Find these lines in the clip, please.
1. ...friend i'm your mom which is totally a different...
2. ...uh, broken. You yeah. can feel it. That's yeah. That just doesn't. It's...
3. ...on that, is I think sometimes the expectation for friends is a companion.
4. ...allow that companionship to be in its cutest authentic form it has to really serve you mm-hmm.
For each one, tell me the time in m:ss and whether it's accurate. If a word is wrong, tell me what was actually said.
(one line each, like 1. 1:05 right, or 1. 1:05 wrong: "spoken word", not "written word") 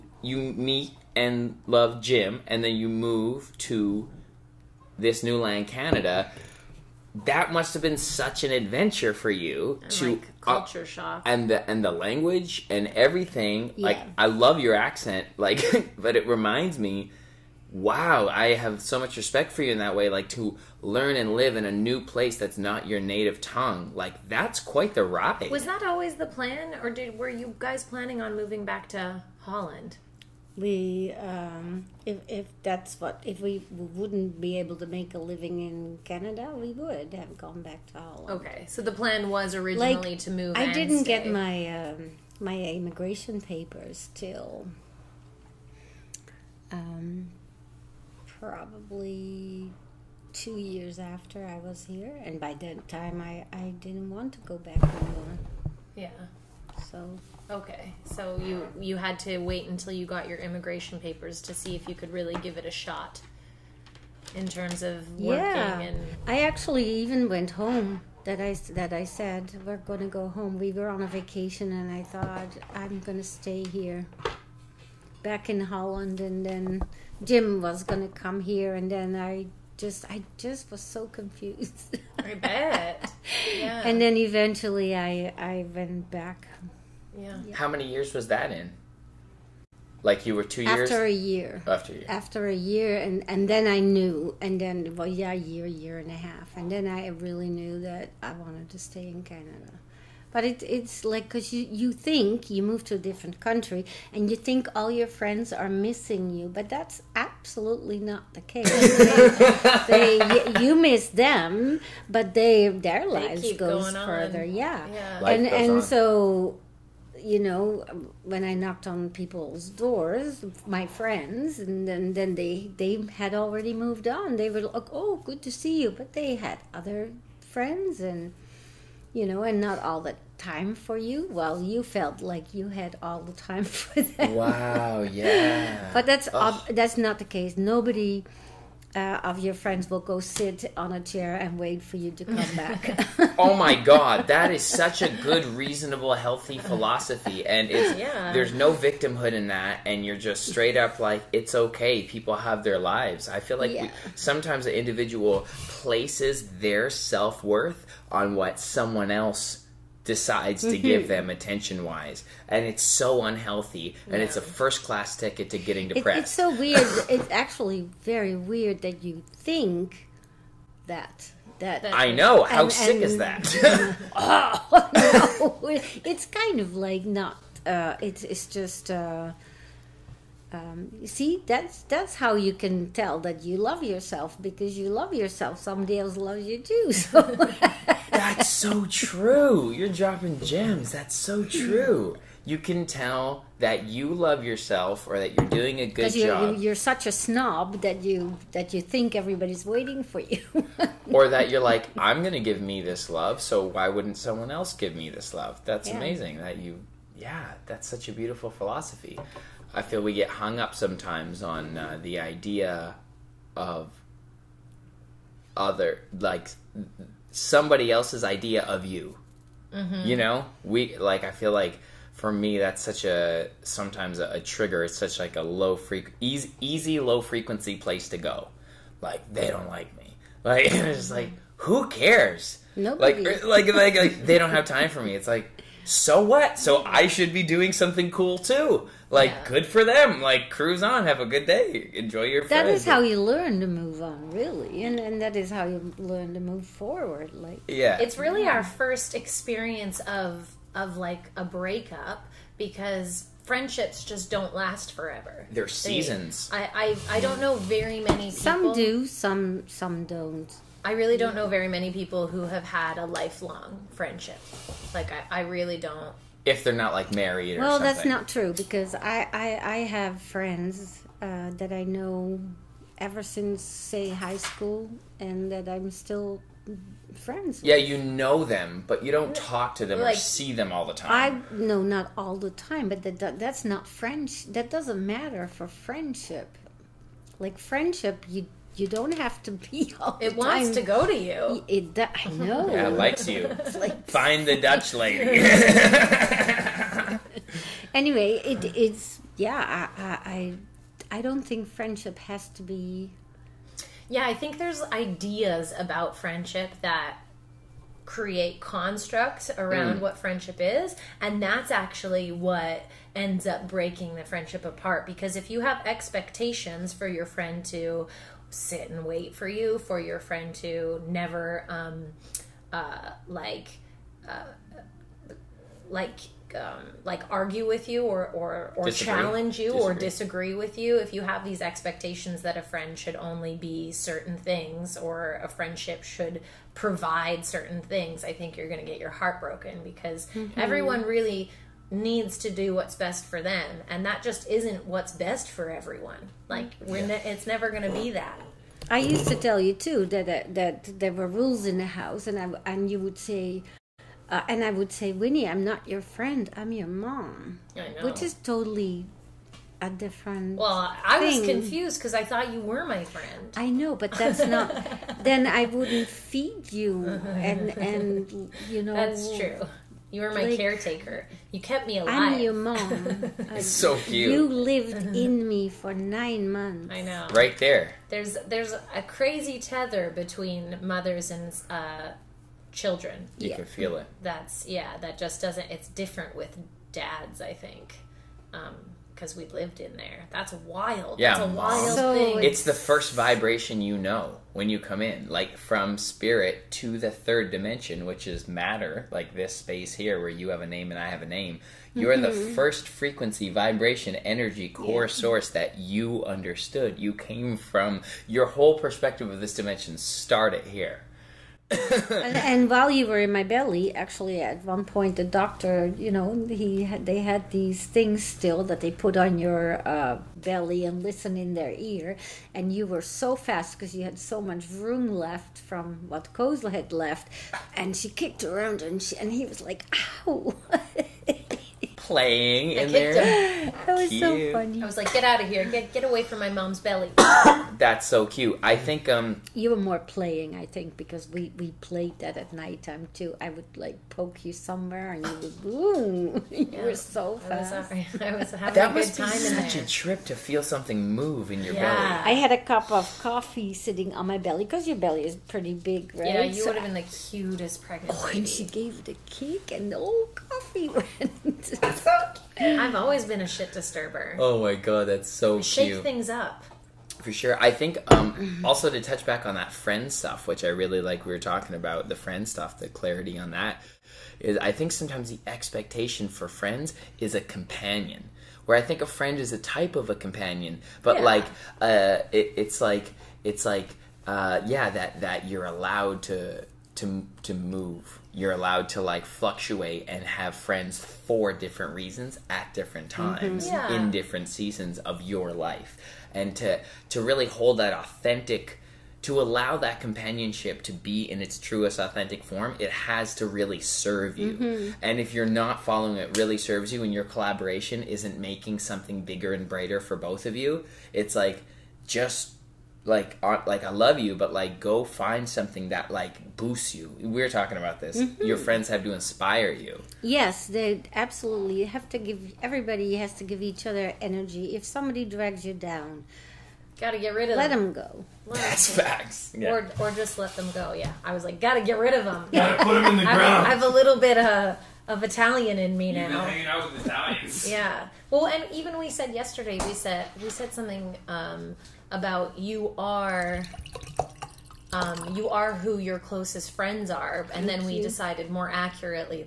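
1. 5:56 right
2. 6:21 wrong: "children", not "broken"
3. 7:53 right
4. 8:19 wrong: "truest", not "cutest".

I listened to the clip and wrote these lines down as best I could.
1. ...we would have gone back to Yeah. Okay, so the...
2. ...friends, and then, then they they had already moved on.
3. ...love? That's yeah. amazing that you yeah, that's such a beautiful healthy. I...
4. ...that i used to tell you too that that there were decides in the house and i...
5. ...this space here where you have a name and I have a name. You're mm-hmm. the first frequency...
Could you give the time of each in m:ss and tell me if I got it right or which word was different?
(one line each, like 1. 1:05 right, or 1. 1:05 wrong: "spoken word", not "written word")
1. 0:36 wrong: "Holland", not "Yeah"
2. 2:00 right
3. 3:25 wrong: "philosophy", not "healthy"
4. 5:48 wrong: "rules", not "decides"
5. 6:39 right.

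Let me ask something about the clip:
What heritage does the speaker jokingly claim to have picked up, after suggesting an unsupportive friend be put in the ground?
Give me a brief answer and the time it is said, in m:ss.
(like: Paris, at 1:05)
Italian, at 8:55.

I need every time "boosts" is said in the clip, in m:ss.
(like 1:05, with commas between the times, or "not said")
8:36.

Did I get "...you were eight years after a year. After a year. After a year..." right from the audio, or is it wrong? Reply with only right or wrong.
wrong.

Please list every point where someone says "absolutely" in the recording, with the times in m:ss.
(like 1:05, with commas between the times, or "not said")
1:47, 8:41.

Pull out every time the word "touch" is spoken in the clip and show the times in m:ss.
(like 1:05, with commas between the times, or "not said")
7:49.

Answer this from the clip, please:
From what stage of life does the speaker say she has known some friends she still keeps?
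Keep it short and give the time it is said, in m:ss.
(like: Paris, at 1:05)
High school, at 4:34.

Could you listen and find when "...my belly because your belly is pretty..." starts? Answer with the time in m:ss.
7:34.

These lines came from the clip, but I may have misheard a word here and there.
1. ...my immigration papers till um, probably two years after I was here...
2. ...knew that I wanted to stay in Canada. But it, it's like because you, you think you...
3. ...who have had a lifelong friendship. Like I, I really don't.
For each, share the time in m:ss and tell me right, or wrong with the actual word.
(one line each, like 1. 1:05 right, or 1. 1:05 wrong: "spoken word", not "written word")
1. 0:42 right
2. 1:37 right
3. 4:22 right.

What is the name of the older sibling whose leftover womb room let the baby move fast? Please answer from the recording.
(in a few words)
Kozla.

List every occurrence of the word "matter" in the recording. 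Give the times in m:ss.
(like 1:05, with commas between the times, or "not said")
4:45, 6:38.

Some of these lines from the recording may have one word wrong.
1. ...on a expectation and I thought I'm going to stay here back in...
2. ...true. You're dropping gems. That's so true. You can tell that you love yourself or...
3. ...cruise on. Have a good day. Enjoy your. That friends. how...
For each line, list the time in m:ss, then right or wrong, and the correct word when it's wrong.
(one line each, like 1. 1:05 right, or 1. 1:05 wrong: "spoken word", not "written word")
1. 1:10 wrong: "vacation", not "expectation"
2. 3:08 right
3. 4:00 right.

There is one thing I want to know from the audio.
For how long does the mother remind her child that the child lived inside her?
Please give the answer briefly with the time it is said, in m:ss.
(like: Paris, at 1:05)
9 months, at 6:15.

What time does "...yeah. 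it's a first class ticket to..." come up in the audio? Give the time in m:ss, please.
2:44.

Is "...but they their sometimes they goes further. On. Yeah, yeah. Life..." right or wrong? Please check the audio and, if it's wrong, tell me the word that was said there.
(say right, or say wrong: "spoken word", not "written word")
wrong: "lives", not "sometimes".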